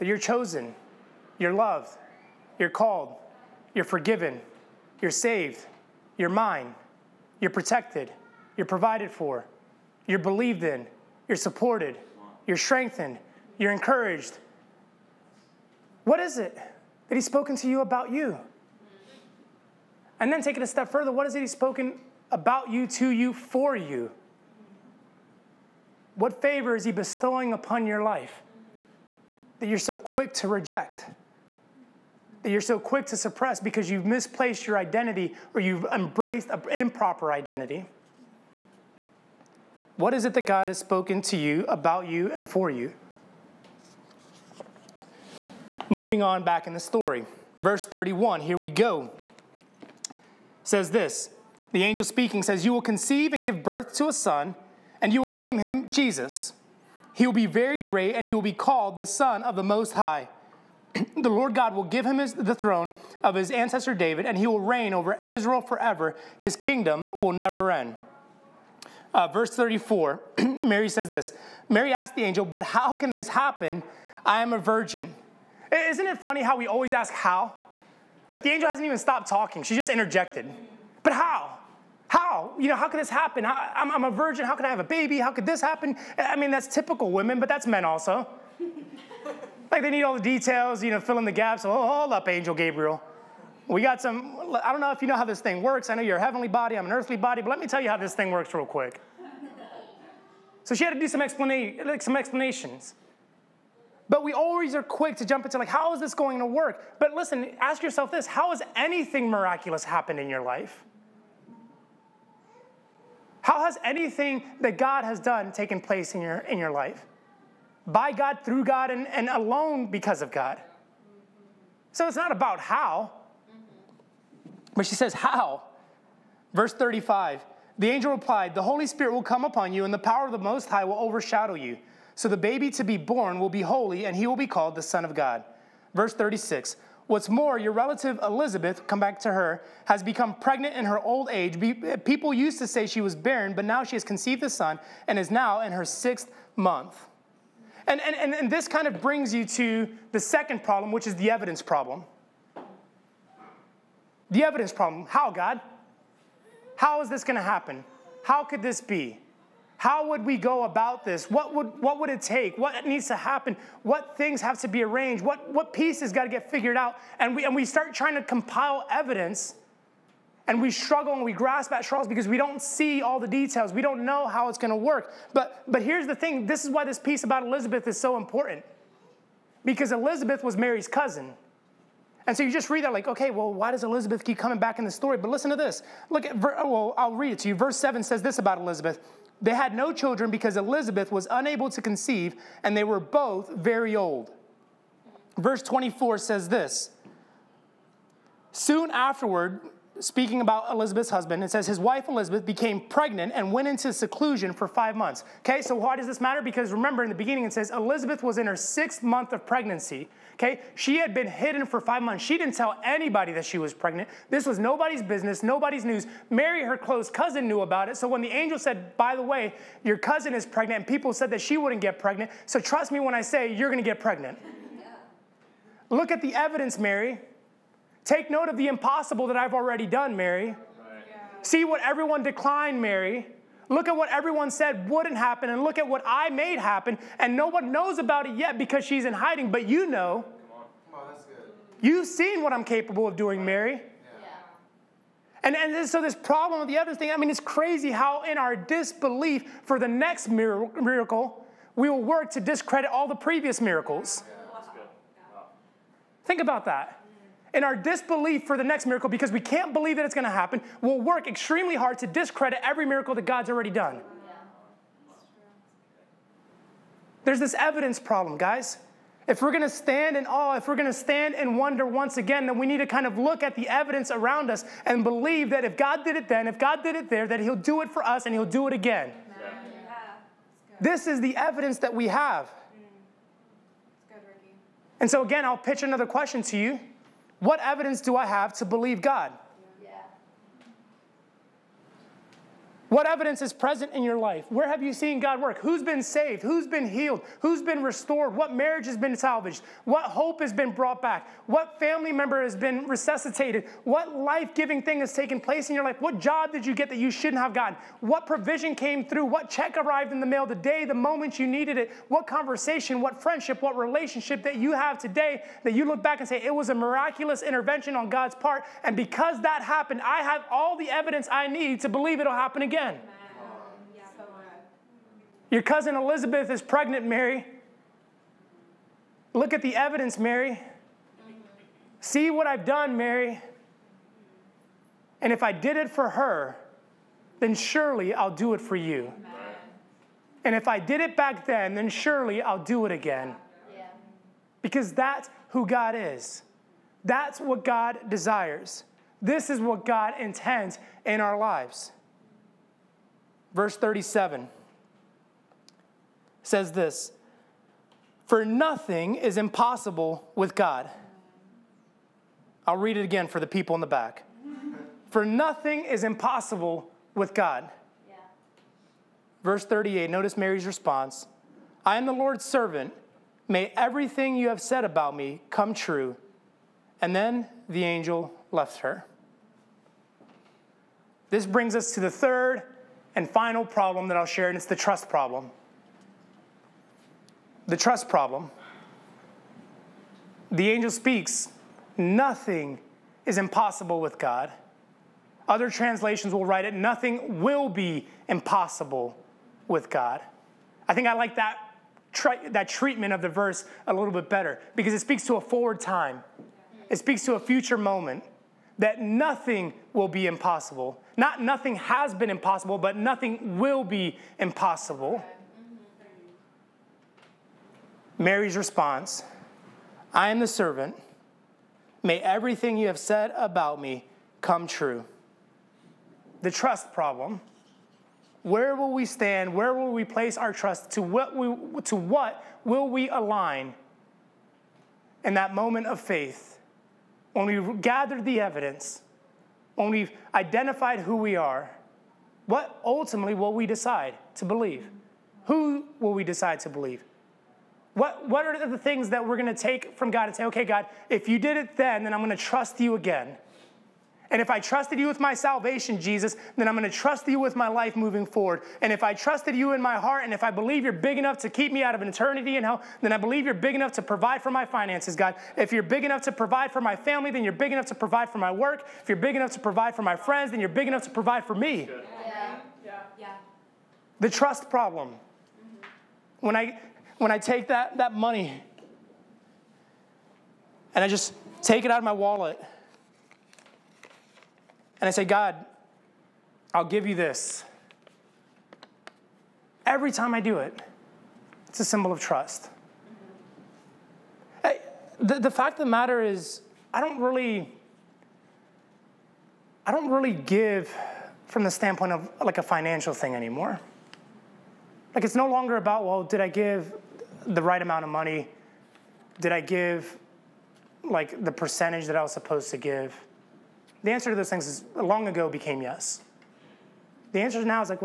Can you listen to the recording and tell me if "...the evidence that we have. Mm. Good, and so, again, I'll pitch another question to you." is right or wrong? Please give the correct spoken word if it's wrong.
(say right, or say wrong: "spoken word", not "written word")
right.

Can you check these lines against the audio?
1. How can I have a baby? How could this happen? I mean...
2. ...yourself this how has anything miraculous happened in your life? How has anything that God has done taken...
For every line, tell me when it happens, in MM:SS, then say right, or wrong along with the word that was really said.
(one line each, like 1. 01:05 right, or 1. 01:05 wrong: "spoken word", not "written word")
1. 01:24 right
2. 01:47 right.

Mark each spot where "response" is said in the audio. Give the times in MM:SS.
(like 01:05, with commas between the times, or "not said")
06:10, 06:58.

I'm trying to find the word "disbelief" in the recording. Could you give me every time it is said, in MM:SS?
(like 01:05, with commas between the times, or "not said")
04:08, 04:17.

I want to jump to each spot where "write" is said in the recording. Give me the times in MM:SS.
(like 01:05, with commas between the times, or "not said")
06:36.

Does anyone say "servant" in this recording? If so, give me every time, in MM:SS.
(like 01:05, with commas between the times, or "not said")
06:12, 07:00.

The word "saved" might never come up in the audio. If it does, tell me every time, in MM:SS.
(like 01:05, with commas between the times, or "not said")
00:05, 04:56.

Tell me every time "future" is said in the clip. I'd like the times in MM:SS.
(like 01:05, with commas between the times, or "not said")
06:47.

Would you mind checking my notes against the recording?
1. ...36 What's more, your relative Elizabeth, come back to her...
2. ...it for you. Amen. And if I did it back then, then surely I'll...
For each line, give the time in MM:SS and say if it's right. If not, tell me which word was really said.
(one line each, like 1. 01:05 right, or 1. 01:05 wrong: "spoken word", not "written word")
1. 02:16 right
2. 05:38 right.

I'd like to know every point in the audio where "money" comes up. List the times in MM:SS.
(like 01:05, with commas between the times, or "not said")
07:58, 08:28.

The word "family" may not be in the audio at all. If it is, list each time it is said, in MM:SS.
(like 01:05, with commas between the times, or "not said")
05:01, 07:46.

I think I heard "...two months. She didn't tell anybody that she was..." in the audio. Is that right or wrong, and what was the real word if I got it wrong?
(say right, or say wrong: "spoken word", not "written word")
wrong: "five", not "two".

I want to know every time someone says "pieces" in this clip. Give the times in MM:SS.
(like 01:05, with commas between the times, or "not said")
02:45, 02:56.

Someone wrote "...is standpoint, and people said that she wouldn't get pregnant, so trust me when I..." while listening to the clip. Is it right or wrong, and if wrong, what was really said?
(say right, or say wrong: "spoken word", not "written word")
wrong: "pregnant", not "standpoint".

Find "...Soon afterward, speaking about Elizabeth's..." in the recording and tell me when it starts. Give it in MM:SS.
03:18.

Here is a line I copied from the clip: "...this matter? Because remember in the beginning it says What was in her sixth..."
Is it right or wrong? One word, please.
wrong.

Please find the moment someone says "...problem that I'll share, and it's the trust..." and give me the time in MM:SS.
06:23.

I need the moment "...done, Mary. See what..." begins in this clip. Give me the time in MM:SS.
03:49.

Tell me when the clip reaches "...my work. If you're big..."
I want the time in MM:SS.
07:48.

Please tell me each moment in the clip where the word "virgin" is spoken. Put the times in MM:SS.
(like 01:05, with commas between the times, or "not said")
01:14, 01:24.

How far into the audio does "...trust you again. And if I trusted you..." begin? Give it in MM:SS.
07:32.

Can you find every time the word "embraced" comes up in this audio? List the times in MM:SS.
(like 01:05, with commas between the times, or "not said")
00:35.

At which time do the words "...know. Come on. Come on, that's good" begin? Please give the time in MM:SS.
03:59.